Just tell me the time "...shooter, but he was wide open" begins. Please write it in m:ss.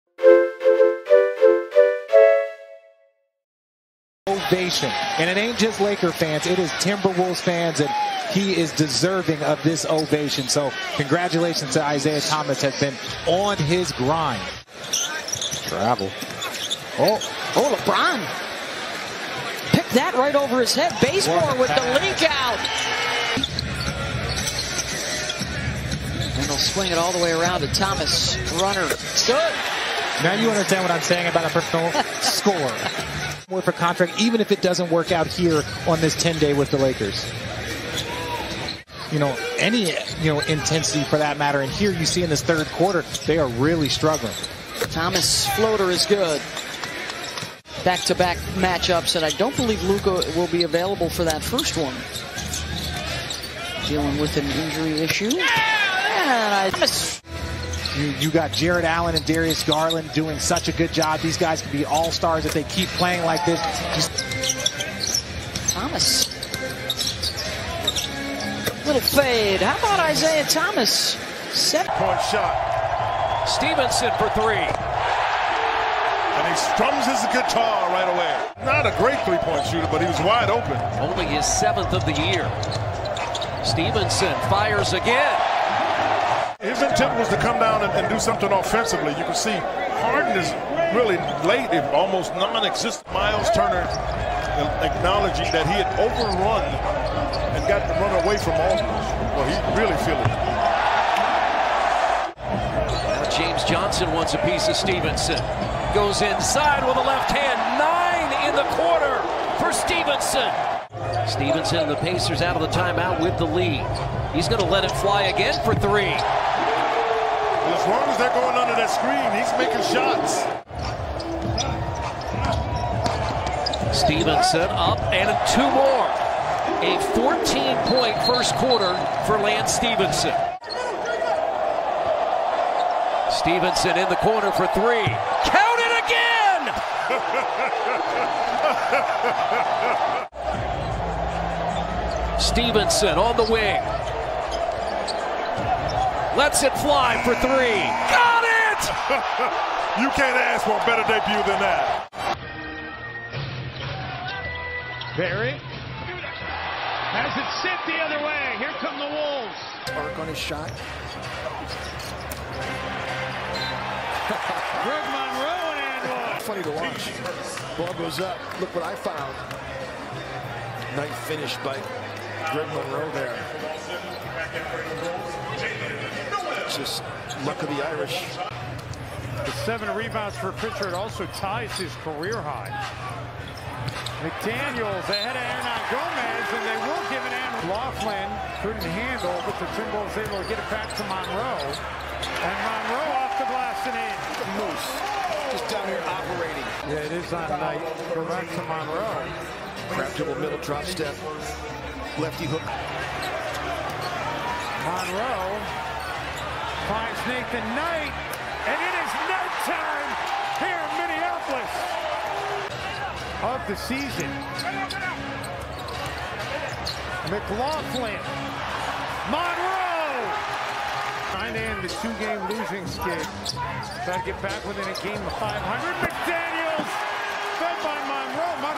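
1:19.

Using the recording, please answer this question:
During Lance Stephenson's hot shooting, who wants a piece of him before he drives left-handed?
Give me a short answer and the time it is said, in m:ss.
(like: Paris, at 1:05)
James Johnson, at 1:43.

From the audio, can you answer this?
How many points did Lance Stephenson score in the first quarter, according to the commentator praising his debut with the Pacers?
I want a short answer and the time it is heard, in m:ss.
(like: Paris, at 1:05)
14, at 2:07.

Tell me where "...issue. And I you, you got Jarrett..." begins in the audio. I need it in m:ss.
0:55.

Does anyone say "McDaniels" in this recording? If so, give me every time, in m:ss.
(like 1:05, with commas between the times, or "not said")
3:04, 3:46.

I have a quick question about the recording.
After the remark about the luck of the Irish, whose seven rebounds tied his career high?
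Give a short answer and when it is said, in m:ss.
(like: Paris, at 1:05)
Pritchard, at 3:00.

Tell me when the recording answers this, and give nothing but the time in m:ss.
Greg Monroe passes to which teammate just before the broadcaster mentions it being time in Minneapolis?
3:27.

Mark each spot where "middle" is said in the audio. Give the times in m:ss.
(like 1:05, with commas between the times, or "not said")
3:20.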